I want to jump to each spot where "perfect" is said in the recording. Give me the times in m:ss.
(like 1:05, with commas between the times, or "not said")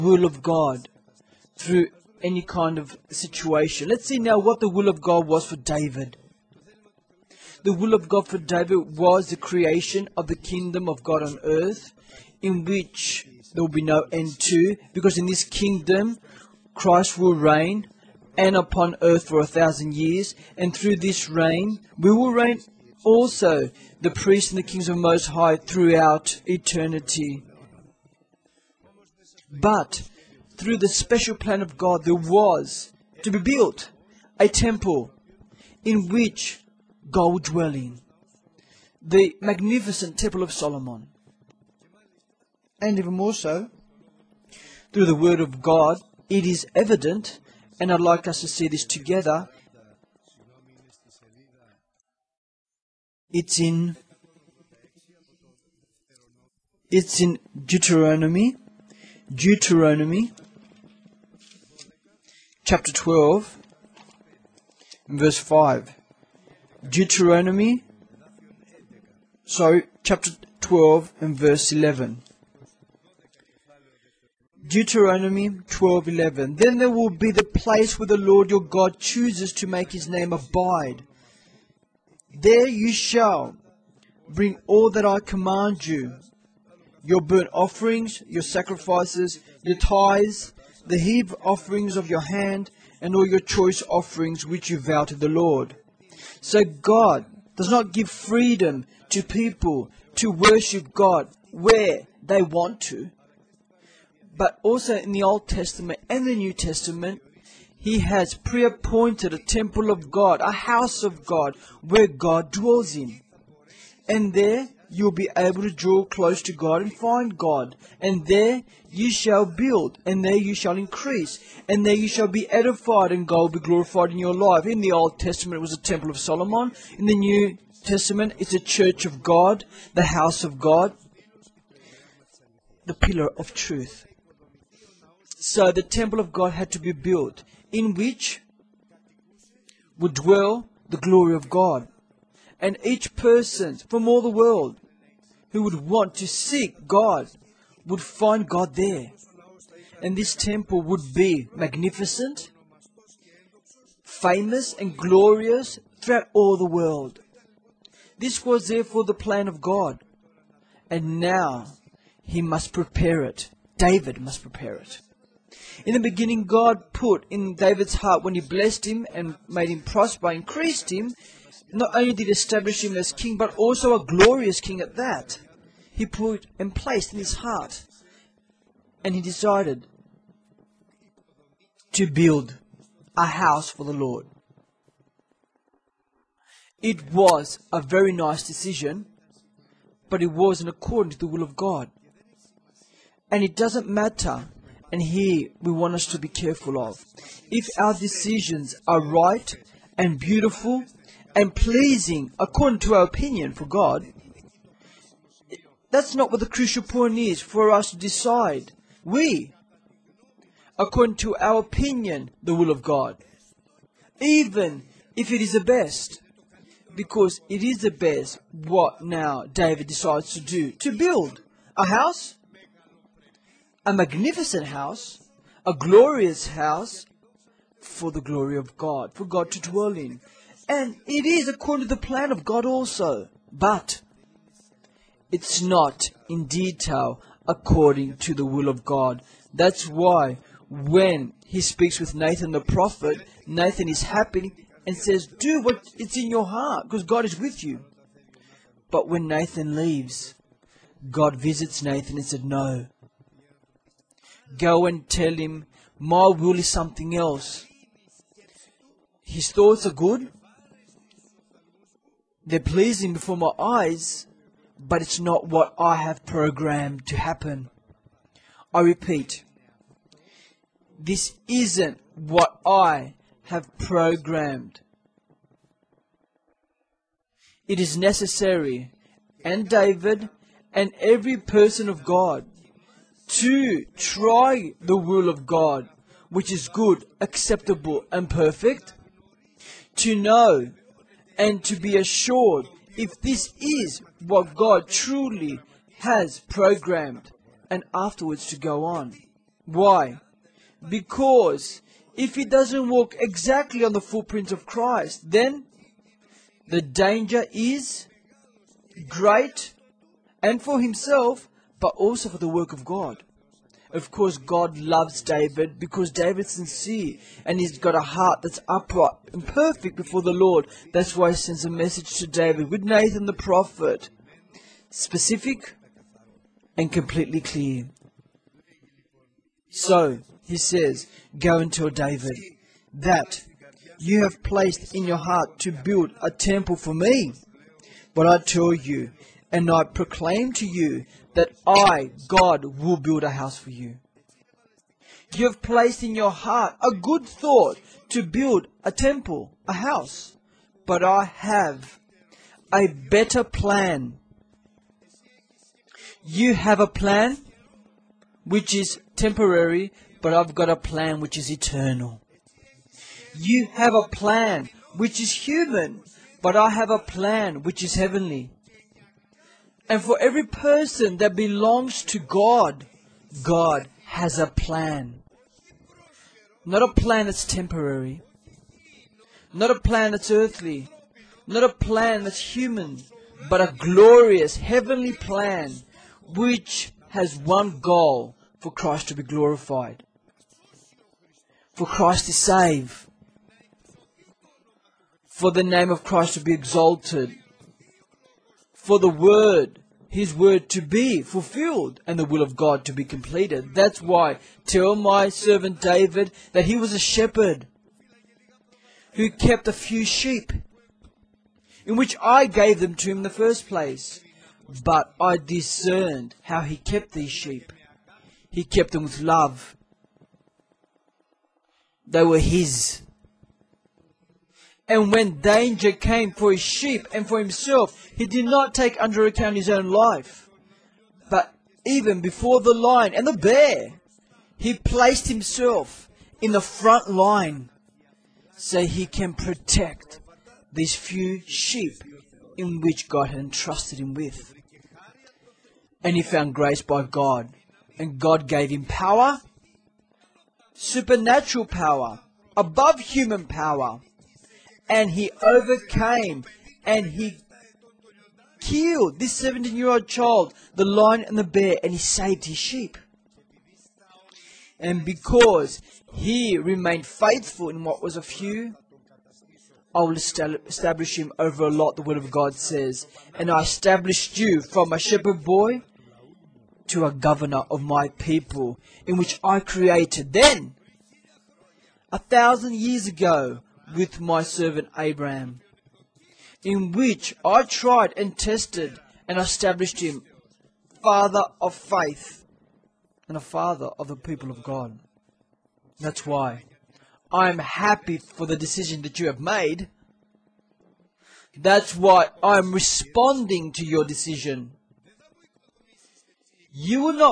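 4:48, 5:19.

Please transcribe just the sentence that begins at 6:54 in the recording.
But I discerned how he kept these sheep.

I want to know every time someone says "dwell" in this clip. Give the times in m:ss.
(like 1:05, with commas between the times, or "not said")
0:37, 1:52, 2:20, 3:49.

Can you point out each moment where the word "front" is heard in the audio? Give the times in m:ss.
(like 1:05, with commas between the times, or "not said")
7:16.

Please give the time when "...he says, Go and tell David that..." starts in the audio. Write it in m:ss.
5:30.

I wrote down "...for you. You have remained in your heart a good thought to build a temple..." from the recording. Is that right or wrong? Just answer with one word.
wrong.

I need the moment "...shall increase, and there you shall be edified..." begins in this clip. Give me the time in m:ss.
2:00.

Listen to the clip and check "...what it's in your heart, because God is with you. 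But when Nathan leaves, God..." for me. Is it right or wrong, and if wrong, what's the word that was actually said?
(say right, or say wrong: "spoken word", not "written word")
right.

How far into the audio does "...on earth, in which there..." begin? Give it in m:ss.
0:11.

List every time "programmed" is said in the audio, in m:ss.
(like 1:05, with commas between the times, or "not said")
4:26, 4:33, 4:56.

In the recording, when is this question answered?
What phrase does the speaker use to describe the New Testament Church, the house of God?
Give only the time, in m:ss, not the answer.
2:12.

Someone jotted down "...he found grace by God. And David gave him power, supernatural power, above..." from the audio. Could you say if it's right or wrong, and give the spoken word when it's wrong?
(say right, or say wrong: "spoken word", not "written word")
wrong: "God", not "David".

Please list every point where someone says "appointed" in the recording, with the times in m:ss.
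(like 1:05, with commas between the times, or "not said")
1:48.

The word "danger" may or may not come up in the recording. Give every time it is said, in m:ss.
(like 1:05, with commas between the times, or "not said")
5:06, 7:05.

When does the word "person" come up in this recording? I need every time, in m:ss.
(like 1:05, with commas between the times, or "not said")
2:23, 4:41, 6:10.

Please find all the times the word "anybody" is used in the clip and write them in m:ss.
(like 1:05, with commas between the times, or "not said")
not said.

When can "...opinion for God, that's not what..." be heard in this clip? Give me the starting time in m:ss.
3:23.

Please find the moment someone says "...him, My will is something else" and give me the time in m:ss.
4:15.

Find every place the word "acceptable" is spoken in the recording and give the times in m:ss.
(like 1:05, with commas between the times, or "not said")
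4:47.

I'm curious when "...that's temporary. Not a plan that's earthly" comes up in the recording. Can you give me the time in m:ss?
6:17.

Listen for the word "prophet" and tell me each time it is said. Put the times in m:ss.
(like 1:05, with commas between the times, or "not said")
4:02, 5:23.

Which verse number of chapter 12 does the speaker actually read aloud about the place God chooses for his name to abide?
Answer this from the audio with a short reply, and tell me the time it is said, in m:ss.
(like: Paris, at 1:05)
11, at 1:11.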